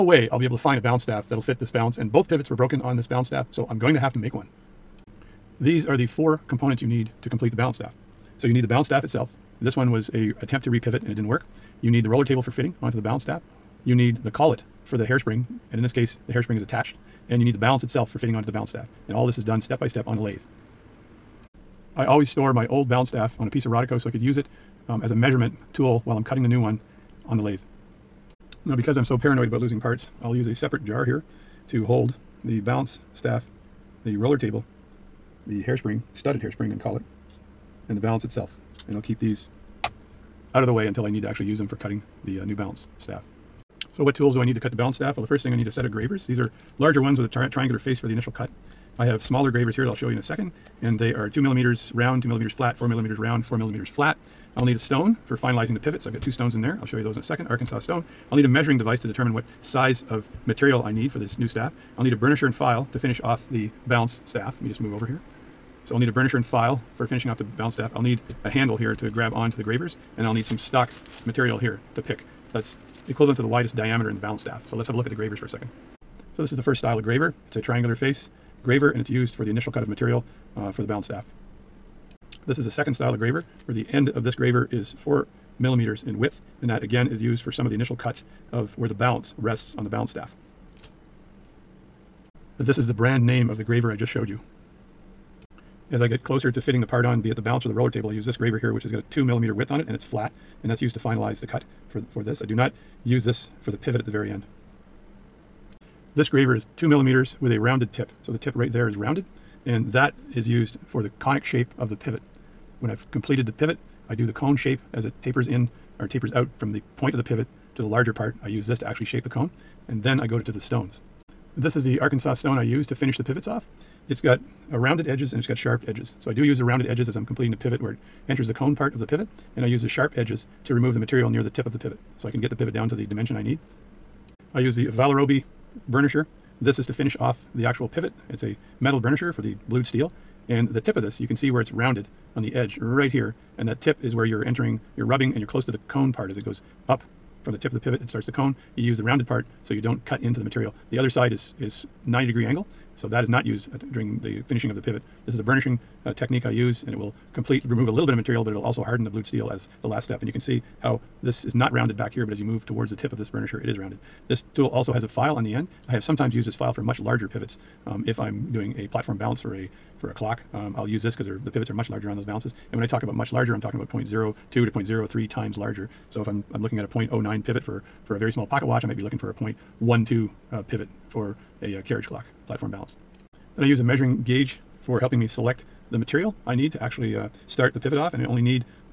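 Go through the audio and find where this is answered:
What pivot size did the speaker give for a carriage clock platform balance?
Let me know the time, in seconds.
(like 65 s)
179 s.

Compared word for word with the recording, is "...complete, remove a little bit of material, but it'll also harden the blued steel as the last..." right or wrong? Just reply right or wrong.
right.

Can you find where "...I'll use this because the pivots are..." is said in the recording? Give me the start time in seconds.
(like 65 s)
170 s.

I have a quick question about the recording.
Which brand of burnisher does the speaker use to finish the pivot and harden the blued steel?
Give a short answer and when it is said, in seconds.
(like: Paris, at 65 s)
Vallorbe, at 134 s.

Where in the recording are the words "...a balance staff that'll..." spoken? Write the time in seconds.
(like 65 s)
0 s.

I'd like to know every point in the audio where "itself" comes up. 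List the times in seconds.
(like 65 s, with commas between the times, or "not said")
9 s, 17 s, 38 s.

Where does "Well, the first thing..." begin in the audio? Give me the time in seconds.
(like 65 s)
45 s.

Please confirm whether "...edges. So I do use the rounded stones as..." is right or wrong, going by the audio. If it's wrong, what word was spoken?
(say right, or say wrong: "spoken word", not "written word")
wrong: "edges", not "stones".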